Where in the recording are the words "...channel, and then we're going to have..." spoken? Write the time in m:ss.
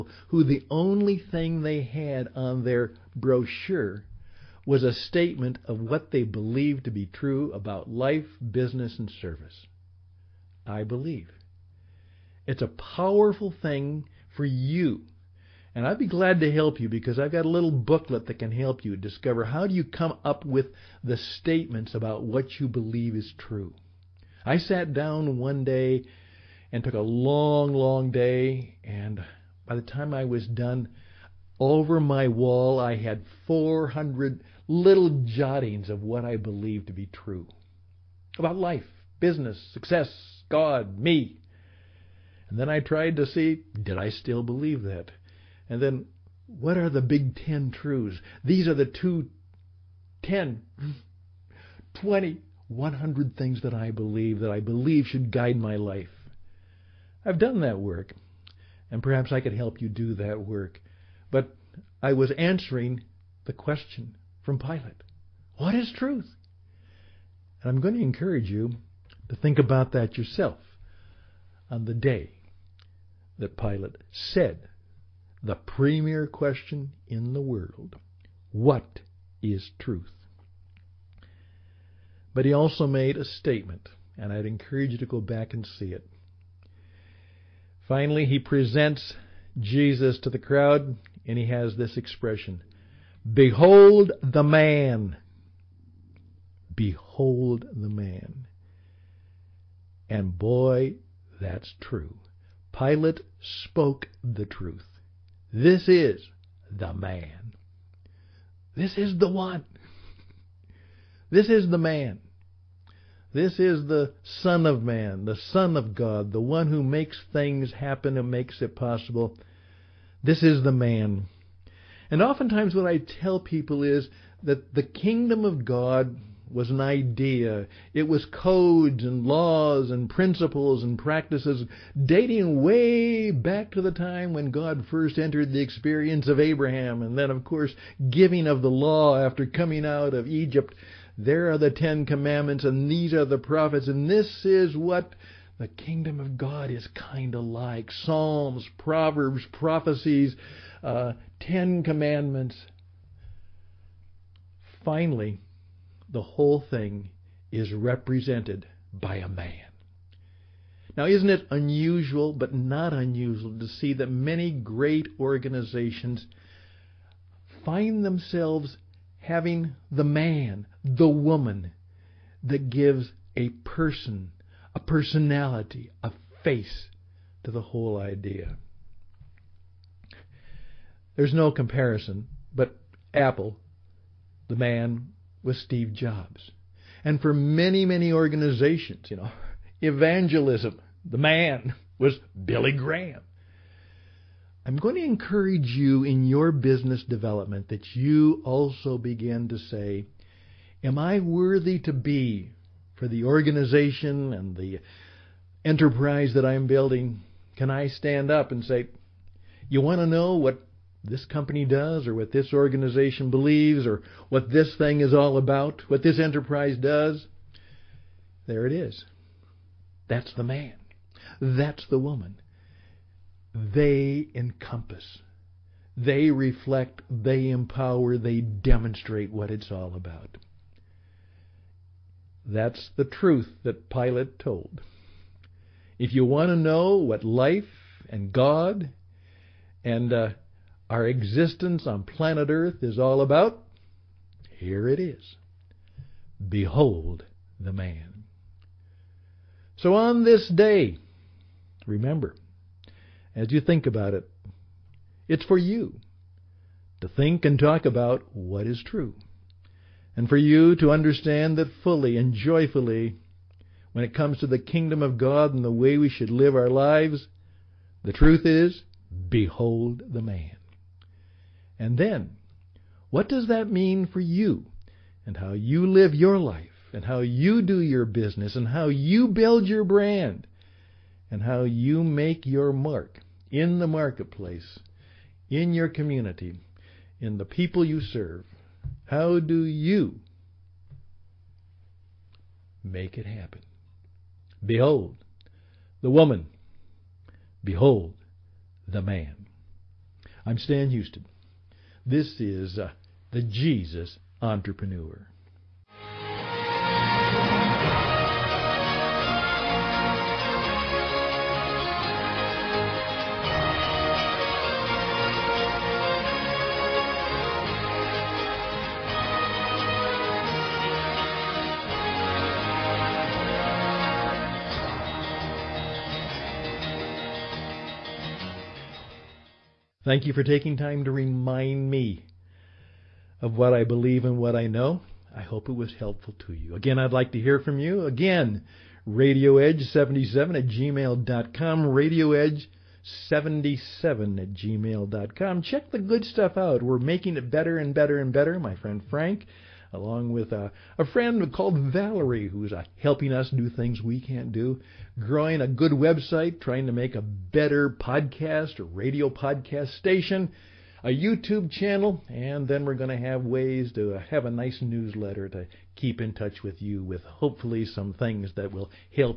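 6:01.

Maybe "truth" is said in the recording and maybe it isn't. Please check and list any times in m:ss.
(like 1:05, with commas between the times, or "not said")
0:47, 1:05, 1:19, 1:44, 3:53, 4:28.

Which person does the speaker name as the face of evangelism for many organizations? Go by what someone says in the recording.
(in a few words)
Billy Graham.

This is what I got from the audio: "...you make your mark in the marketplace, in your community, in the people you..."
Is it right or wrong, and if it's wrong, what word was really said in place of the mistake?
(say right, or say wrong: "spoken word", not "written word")
right.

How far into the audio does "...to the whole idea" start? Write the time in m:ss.
2:57.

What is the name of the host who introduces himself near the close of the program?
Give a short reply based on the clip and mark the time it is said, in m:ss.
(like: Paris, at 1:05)
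Stan Houston, at 5:00.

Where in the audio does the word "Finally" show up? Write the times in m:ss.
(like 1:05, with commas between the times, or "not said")
1:27, 2:34.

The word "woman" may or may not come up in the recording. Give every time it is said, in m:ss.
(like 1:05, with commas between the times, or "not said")
2:51, 3:41, 4:56.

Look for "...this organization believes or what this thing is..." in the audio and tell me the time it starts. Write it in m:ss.
3:32.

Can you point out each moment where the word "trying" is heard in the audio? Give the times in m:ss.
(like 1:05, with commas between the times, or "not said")
5:56.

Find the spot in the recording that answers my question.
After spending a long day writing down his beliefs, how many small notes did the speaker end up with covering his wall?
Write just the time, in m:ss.
0:33.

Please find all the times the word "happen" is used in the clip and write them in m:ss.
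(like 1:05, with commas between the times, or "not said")
1:57, 4:53.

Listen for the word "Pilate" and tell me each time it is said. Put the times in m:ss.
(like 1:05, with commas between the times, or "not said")
1:04, 1:13, 1:42, 3:53.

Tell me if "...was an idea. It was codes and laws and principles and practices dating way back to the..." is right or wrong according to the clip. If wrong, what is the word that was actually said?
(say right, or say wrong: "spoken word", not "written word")
right.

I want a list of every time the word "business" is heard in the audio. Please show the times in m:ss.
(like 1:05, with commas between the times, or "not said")
0:08, 0:39, 3:16, 4:38.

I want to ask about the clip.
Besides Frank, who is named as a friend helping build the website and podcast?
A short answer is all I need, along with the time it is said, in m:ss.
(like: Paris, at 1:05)
Valerie, at 5:51.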